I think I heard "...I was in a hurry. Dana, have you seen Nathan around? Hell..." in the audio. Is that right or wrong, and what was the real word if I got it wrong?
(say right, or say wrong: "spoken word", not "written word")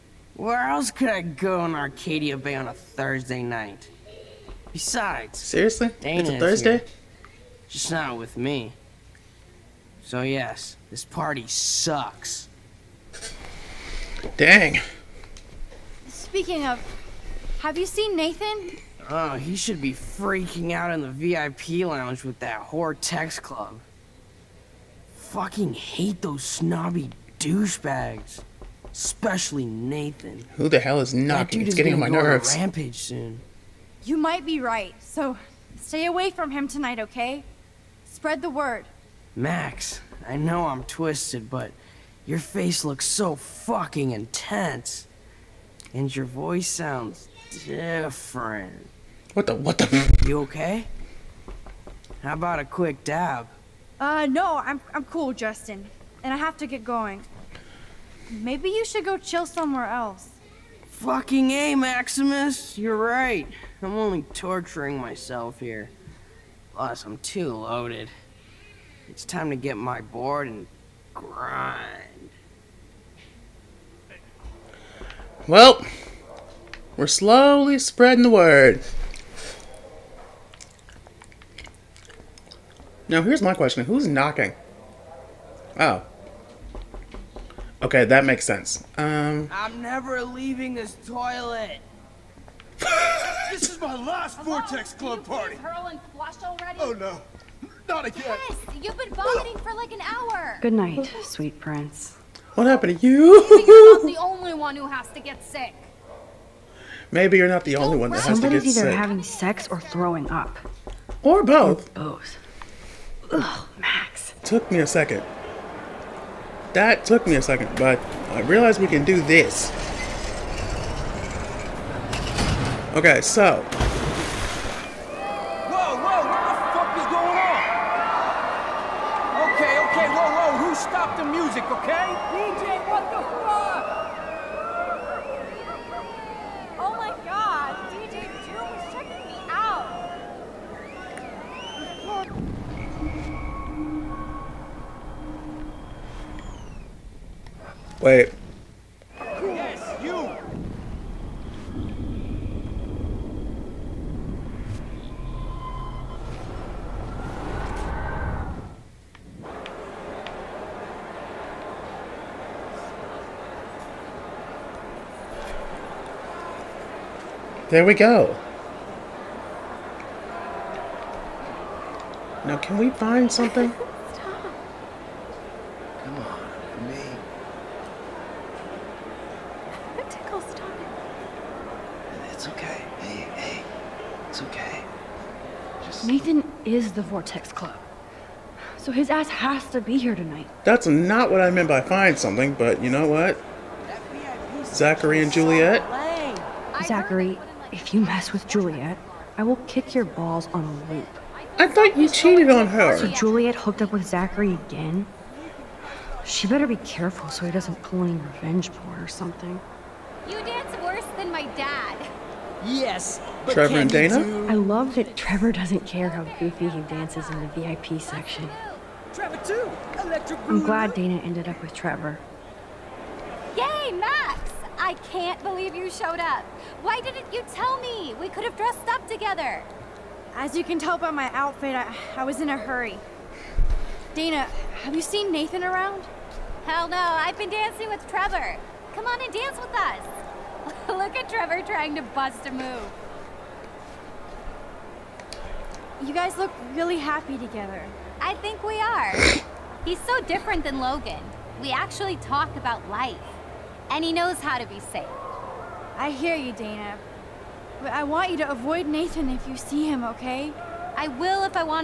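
right.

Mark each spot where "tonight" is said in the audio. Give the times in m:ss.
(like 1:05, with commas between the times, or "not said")
0:36, 3:10.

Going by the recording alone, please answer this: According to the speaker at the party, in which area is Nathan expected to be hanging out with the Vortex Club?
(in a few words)
VIP lounge.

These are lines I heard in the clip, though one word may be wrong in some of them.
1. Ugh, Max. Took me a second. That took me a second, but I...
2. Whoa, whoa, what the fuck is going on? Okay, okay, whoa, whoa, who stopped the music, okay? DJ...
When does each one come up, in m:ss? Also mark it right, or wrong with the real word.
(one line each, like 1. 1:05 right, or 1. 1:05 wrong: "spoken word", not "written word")
1. 1:53 right
2. 2:05 right.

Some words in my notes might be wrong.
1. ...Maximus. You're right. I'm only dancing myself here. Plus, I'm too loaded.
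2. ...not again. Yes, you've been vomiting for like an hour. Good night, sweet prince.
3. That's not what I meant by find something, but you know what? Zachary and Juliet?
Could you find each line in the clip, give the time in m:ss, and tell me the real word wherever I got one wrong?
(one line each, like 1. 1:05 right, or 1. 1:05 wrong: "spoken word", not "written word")
1. 1:01 wrong: "torturing", not "dancing"
2. 1:37 right
3. 3:10 right.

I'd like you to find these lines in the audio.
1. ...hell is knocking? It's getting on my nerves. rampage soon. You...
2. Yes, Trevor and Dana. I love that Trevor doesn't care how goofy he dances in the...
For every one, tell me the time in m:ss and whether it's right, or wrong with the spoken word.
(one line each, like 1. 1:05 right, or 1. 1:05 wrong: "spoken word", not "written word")
1. 0:30 right
2. 3:32 right.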